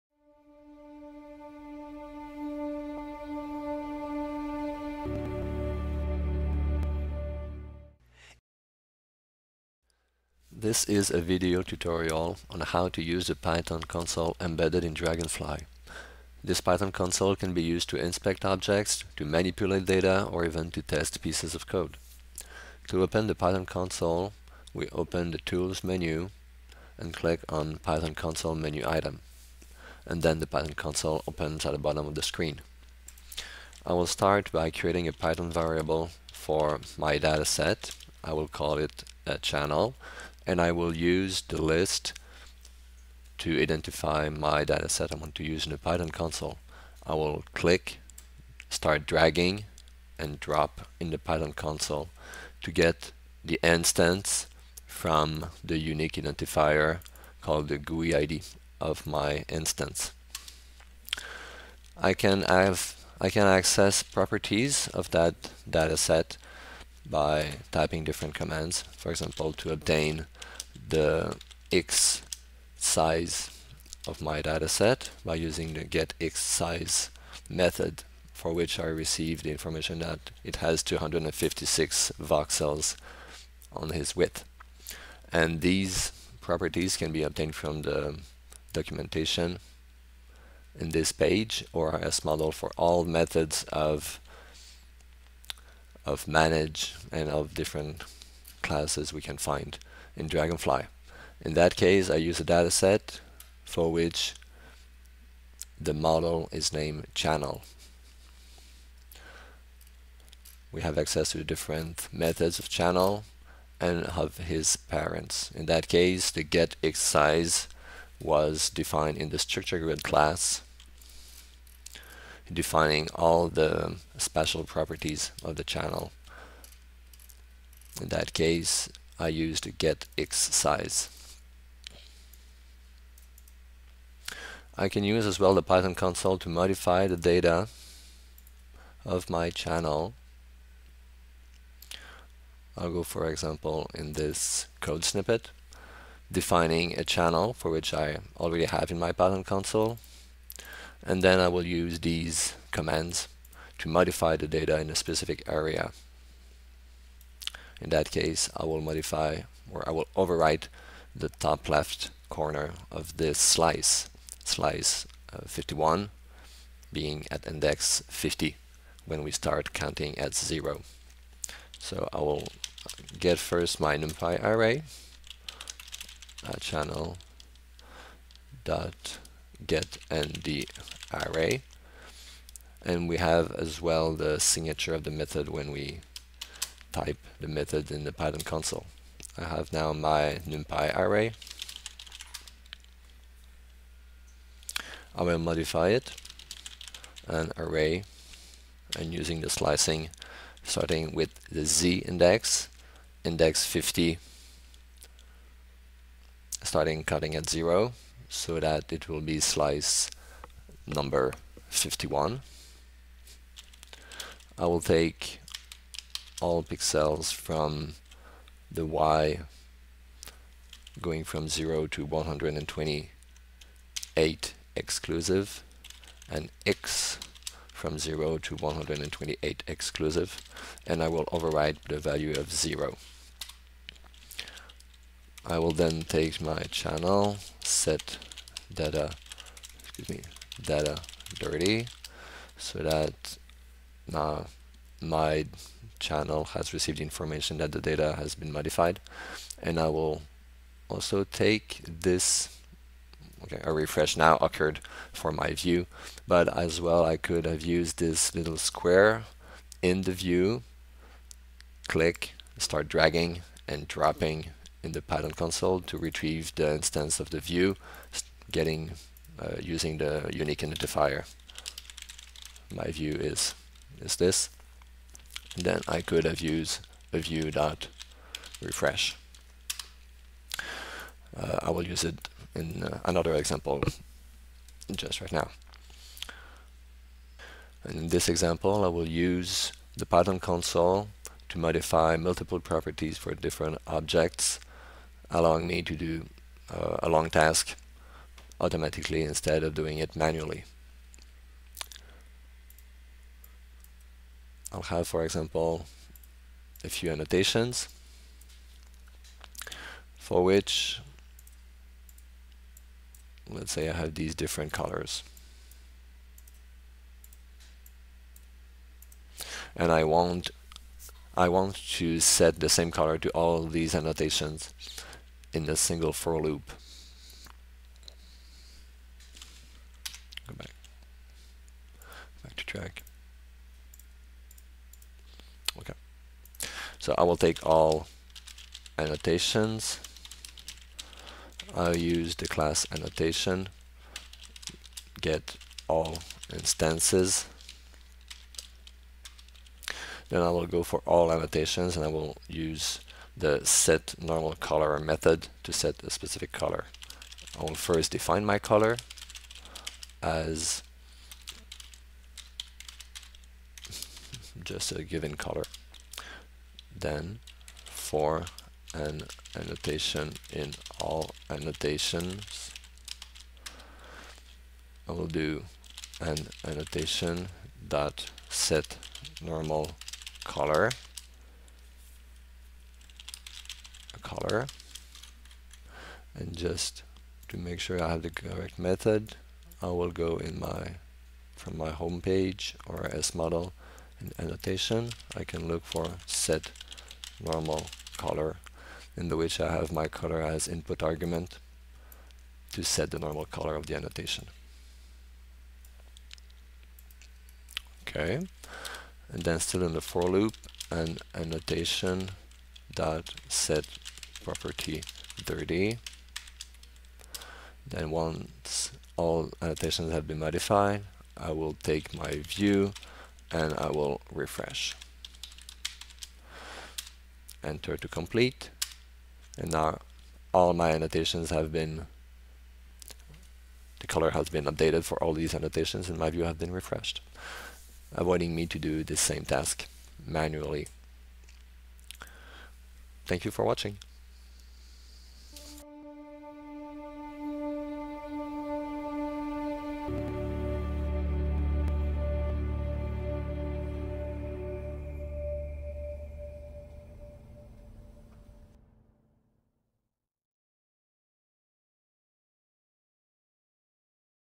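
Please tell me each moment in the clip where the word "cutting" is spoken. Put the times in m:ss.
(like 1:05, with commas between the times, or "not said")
3:27.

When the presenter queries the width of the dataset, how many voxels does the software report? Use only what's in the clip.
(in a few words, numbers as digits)
256.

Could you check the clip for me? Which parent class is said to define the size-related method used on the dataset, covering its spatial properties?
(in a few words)
structure grid.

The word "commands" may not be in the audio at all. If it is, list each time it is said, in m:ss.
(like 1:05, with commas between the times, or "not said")
1:08, 2:32.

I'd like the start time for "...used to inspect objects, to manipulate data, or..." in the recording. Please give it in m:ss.
0:17.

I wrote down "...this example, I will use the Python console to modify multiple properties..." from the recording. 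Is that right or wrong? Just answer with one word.
right.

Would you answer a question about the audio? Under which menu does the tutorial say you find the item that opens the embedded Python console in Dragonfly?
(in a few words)
Tools.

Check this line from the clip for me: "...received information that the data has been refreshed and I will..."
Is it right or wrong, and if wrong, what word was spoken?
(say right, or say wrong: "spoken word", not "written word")
wrong: "modified", not "refreshed".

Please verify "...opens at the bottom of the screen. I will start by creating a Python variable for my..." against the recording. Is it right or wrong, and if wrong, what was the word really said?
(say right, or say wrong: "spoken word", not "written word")
right.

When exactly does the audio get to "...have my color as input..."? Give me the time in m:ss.
6:39.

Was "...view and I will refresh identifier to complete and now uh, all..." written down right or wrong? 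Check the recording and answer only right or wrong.
wrong.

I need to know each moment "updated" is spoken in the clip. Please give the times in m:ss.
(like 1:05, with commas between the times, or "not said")
7:14.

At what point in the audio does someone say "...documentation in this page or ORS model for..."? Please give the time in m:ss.
1:28.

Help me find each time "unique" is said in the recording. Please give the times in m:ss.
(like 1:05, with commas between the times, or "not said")
0:55, 4:30.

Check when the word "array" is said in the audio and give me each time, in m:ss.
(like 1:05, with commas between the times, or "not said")
2:54, 3:01, 3:10, 3:17.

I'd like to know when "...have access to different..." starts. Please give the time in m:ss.
1:50.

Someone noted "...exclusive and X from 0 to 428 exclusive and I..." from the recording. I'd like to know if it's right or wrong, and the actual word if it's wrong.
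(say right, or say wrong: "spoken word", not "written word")
wrong: "128", not "428".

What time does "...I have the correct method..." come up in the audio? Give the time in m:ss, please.
6:28.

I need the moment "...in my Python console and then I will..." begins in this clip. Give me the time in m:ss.
2:28.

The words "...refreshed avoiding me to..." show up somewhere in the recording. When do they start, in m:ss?
7:16.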